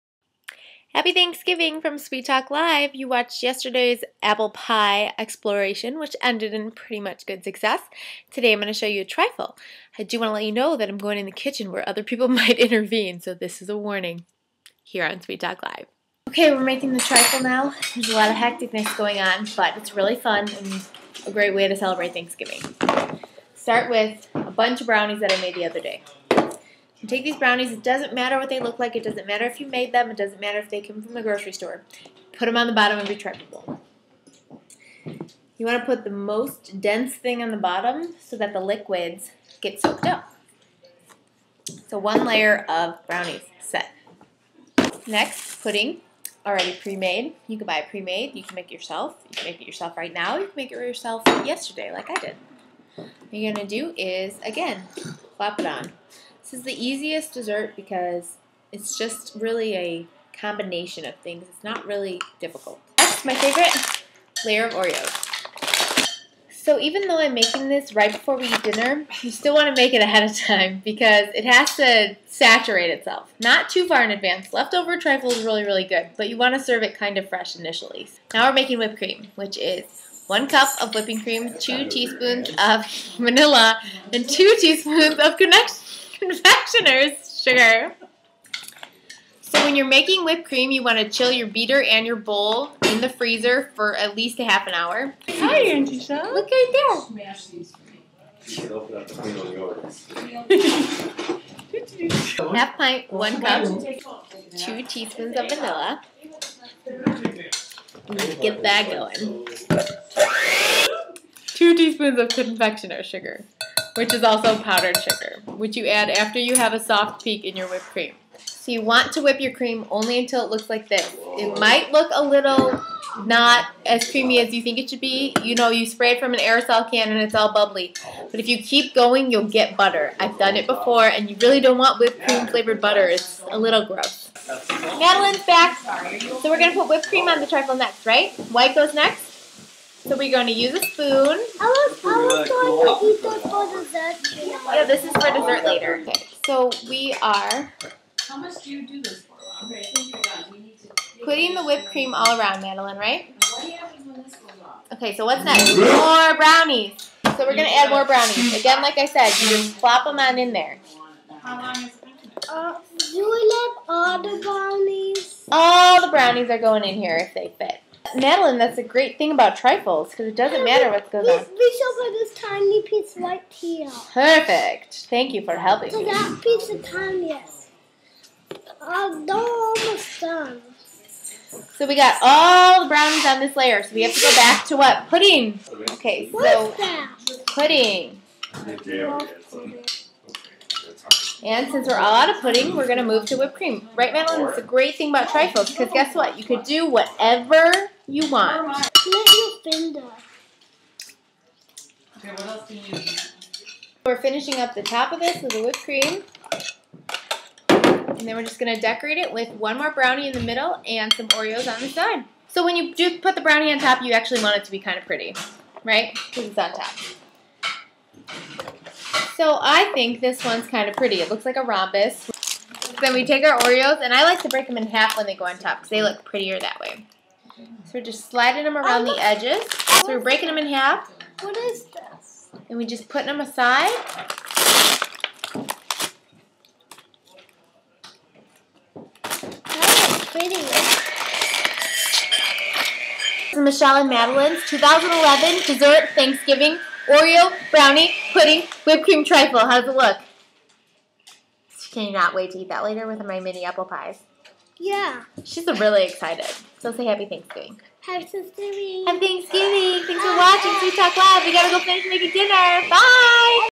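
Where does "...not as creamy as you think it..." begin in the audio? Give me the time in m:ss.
2:03.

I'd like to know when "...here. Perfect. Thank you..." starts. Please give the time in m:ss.
2:53.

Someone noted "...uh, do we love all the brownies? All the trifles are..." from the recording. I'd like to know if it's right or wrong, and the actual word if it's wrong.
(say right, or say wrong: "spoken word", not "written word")
wrong: "brownies", not "trifles".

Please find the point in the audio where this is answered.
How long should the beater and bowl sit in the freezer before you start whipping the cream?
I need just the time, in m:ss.
1:34.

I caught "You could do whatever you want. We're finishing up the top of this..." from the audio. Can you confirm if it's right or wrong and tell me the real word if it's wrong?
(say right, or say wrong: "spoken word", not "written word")
right.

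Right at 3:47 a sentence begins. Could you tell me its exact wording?
So we're just sliding them around the edges.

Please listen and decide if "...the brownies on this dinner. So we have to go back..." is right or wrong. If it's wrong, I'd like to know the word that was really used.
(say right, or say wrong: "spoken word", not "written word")
wrong: "layer", not "dinner".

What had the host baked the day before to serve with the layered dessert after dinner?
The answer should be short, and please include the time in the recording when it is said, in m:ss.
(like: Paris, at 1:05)
mini apple pies, at 4:13.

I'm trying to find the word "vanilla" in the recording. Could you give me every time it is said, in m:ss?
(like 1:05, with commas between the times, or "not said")
1:23, 1:45.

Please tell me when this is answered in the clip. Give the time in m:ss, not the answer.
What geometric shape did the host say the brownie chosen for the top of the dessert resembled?
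3:41.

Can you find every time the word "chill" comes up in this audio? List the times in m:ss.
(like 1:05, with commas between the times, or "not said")
1:31.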